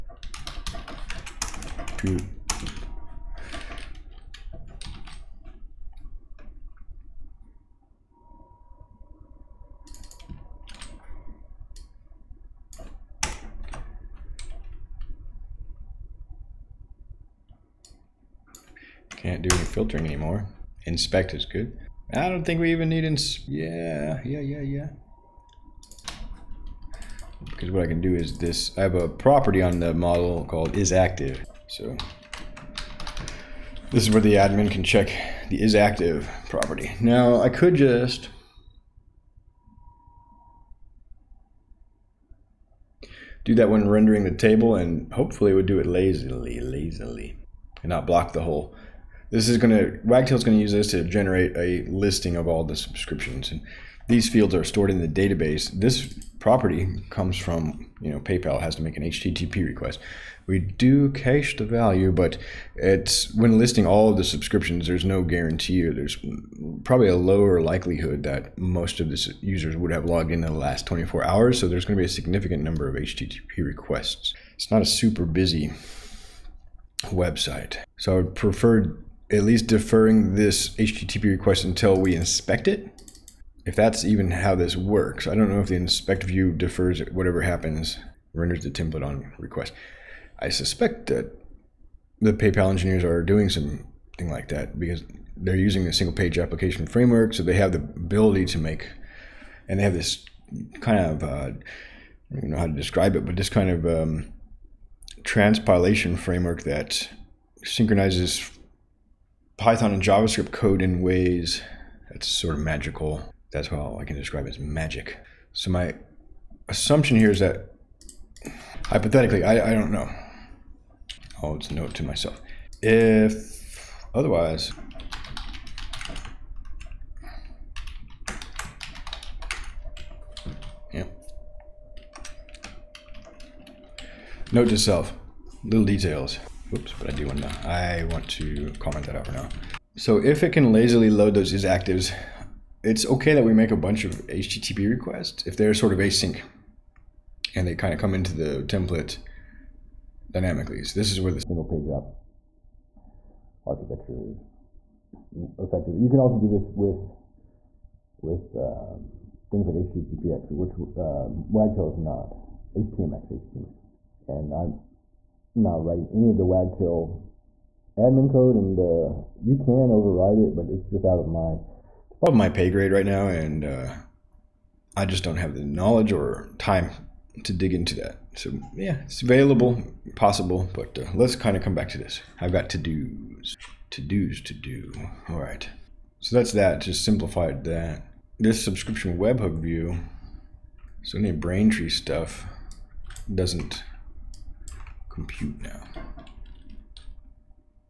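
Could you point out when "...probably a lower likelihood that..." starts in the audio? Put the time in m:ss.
1:06.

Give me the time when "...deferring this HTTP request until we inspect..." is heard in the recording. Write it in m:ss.
1:19.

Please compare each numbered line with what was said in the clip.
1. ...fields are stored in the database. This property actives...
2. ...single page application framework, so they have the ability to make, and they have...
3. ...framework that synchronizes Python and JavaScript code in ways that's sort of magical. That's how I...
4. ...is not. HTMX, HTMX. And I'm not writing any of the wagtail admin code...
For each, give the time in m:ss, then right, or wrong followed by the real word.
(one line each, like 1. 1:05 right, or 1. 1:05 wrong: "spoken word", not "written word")
1. 0:54 wrong: "comes", not "actives"
2. 1:35 right
3. 1:46 right
4. 2:41 right.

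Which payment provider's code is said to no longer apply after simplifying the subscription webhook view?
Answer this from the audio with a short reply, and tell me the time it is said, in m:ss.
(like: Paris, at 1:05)
Braintree, at 3:11.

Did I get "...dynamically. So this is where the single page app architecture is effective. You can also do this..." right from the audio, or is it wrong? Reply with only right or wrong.
right.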